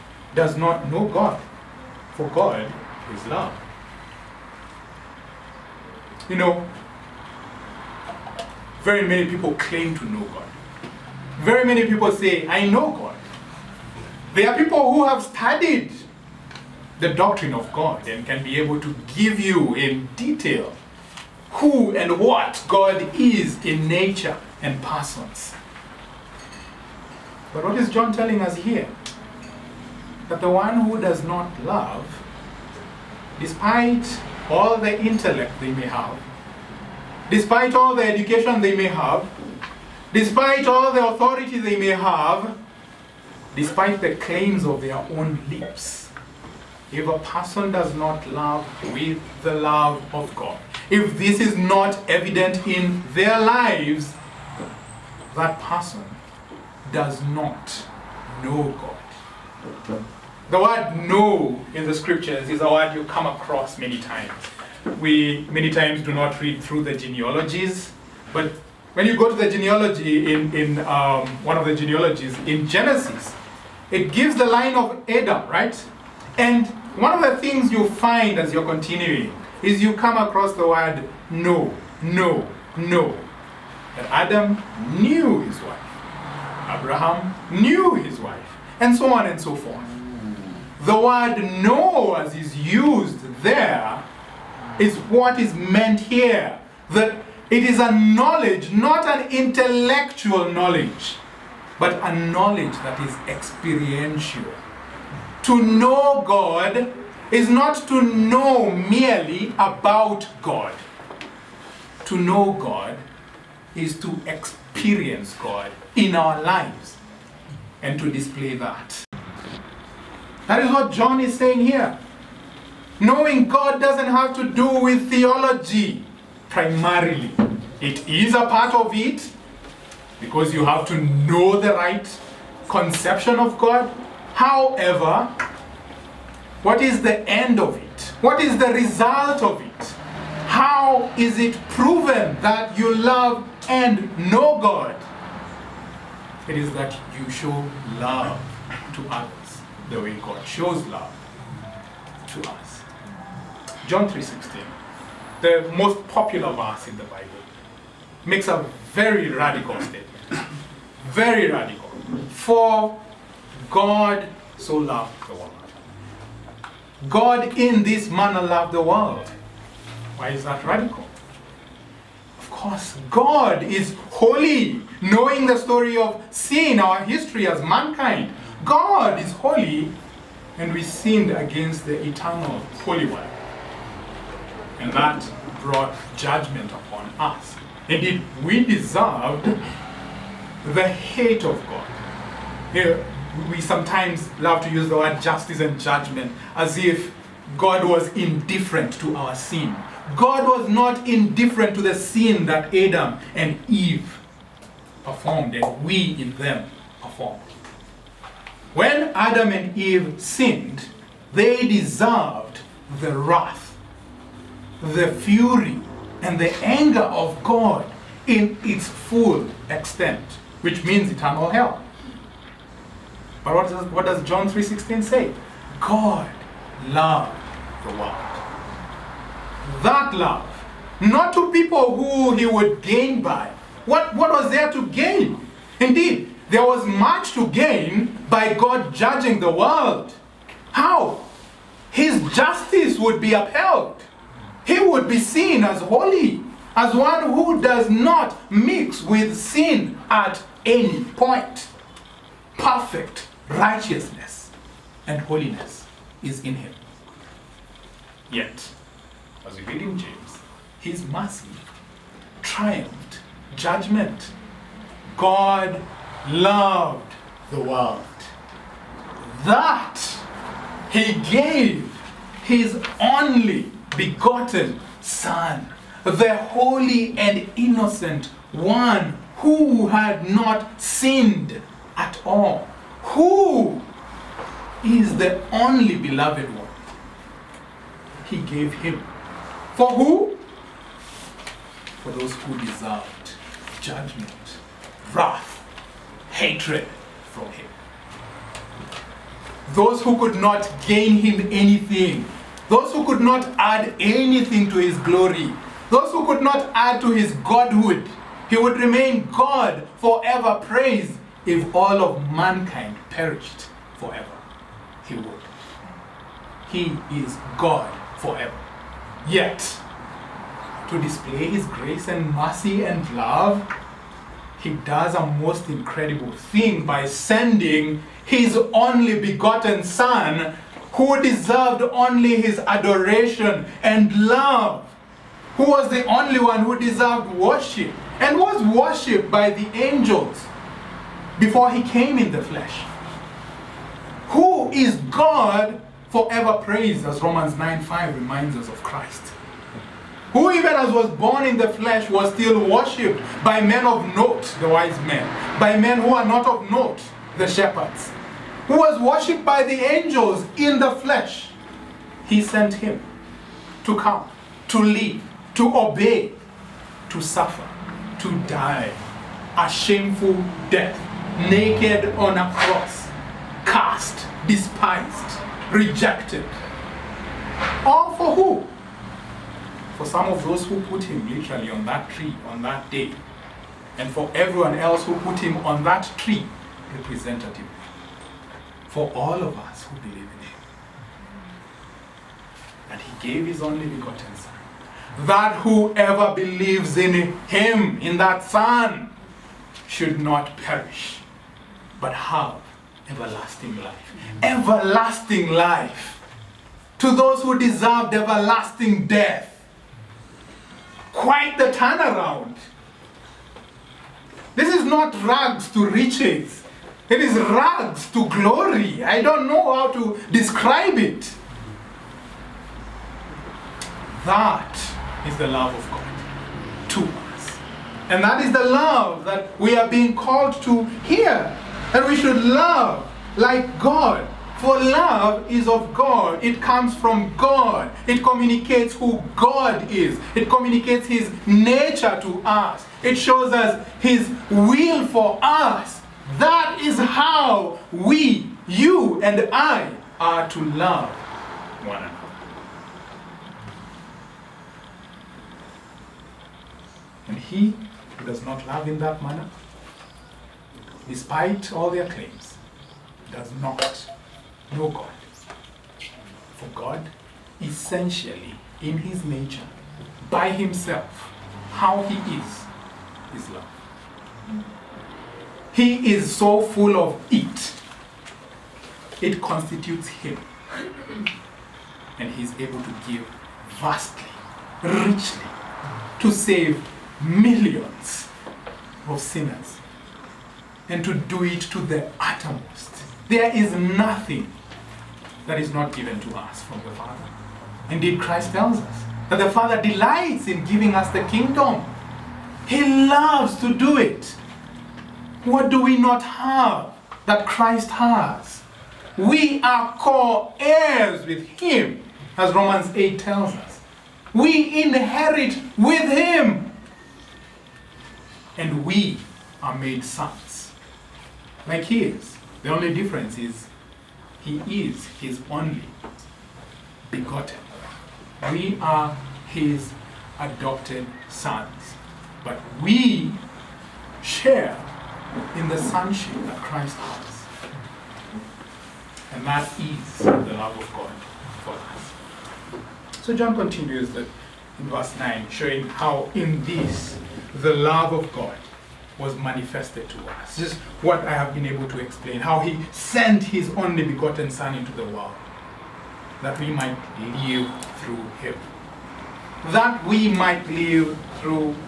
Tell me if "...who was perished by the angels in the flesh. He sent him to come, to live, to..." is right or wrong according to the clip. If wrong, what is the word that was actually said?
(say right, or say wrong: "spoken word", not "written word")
wrong: "worshipped", not "perished".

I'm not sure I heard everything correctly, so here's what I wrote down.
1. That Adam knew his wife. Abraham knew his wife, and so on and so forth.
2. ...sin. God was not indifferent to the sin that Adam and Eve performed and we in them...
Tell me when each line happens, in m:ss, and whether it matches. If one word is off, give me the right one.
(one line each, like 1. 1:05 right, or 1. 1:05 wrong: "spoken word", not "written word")
1. 1:23 right
2. 3:19 right.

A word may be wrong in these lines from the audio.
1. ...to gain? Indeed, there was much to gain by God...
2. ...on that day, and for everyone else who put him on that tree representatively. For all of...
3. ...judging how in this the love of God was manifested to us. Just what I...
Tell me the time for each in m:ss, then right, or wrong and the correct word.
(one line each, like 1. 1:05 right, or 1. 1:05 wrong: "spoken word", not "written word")
1. 3:54 right
2. 6:22 right
3. 9:05 wrong: "showing", not "judging".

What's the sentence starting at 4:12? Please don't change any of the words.
Perfect righteousness and holiness is in him.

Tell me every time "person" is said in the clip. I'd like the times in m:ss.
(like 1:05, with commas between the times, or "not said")
0:24, 0:47, 0:55.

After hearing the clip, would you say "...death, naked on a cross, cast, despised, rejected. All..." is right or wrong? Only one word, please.
right.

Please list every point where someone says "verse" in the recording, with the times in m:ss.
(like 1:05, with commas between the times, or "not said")
2:36, 9:04.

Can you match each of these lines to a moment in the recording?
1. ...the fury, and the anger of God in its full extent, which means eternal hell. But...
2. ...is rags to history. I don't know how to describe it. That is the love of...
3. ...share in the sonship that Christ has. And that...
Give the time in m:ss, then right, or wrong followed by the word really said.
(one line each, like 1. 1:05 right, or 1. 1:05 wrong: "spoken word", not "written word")
1. 3:34 right
2. 6:57 wrong: "glory", not "history"
3. 8:54 right.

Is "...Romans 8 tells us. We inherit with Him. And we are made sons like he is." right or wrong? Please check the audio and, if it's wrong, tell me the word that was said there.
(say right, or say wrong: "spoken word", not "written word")
right.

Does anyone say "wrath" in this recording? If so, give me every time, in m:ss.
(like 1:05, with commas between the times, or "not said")
3:33, 4:55.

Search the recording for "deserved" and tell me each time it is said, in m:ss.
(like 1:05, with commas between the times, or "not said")
3:08, 3:31, 4:52, 5:31, 5:36, 6:47.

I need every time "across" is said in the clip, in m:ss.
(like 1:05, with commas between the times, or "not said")
1:03, 1:20.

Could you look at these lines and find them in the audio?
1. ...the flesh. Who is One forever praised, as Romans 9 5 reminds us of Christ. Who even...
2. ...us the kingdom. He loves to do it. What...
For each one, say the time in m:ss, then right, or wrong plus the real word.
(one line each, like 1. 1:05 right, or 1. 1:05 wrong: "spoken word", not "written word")
1. 5:42 wrong: "God", not "One"
2. 8:20 right.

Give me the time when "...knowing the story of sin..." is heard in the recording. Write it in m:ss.
2:55.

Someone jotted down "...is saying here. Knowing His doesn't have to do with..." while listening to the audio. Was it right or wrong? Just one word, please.
wrong.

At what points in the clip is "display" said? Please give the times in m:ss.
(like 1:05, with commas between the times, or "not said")
1:58, 5:21.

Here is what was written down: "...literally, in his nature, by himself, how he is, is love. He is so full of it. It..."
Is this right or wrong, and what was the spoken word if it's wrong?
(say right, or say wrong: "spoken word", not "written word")
wrong: "essentially", not "literally".